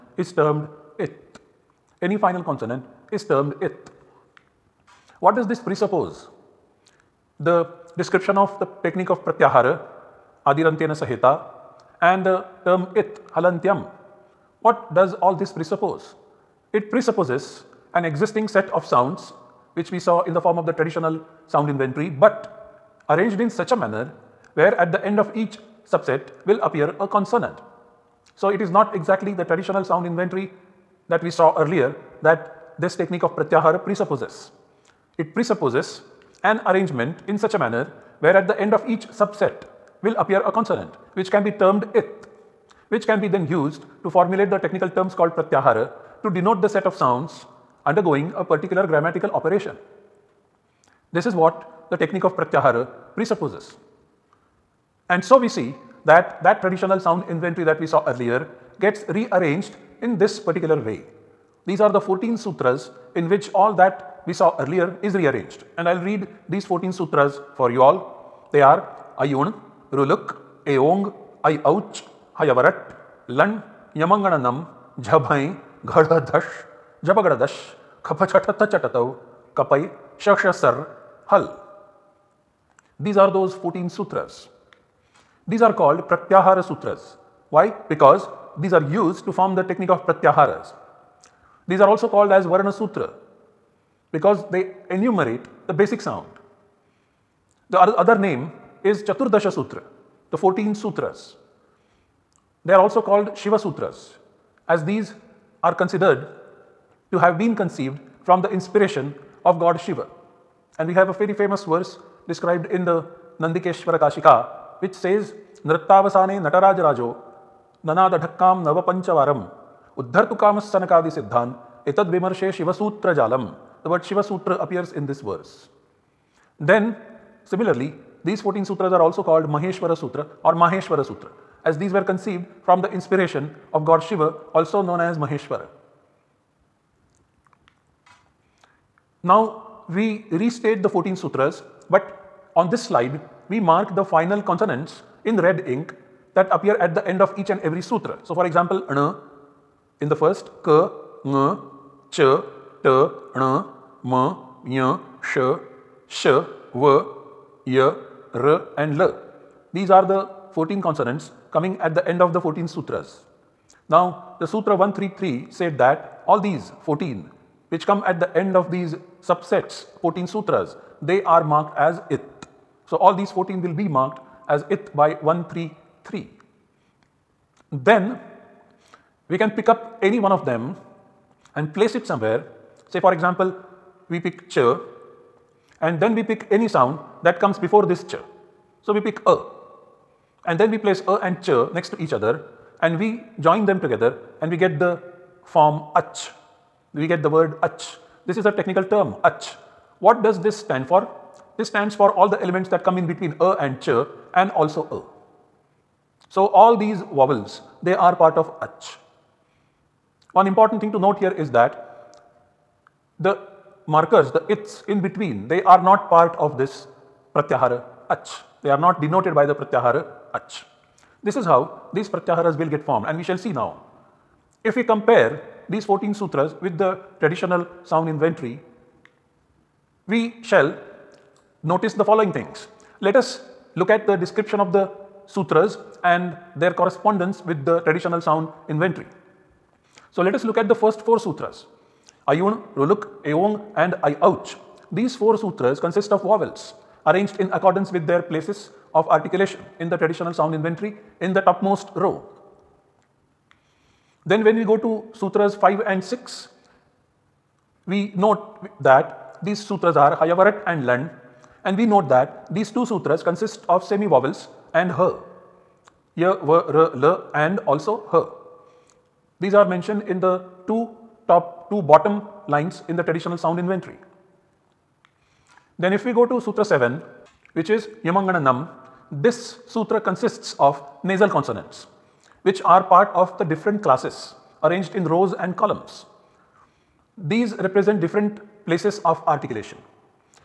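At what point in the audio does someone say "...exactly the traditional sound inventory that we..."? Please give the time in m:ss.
0:28.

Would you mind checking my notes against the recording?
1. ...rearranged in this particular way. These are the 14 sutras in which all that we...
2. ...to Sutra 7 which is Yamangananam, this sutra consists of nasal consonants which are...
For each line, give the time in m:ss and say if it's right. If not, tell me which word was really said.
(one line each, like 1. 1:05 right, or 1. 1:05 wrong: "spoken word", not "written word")
1. 0:59 right
2. 4:36 right.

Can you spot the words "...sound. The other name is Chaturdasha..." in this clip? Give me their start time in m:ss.
1:36.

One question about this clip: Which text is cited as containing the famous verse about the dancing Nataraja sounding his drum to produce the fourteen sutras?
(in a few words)
Nandikeshwara Kashika.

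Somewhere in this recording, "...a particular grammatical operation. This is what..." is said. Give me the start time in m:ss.
0:48.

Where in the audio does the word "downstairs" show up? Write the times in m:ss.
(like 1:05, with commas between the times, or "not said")
not said.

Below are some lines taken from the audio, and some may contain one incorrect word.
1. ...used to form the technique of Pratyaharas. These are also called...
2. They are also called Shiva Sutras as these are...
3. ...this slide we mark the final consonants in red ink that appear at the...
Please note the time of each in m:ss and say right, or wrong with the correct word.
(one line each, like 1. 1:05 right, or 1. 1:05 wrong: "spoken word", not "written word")
1. 1:29 right
2. 1:42 right
3. 2:22 right.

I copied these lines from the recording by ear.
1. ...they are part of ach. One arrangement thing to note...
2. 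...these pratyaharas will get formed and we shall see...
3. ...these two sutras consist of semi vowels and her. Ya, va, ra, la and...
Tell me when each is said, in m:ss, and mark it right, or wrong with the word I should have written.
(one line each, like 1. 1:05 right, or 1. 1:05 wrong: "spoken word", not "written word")
1. 3:27 wrong: "important", not "arrangement"
2. 3:41 right
3. 4:22 right.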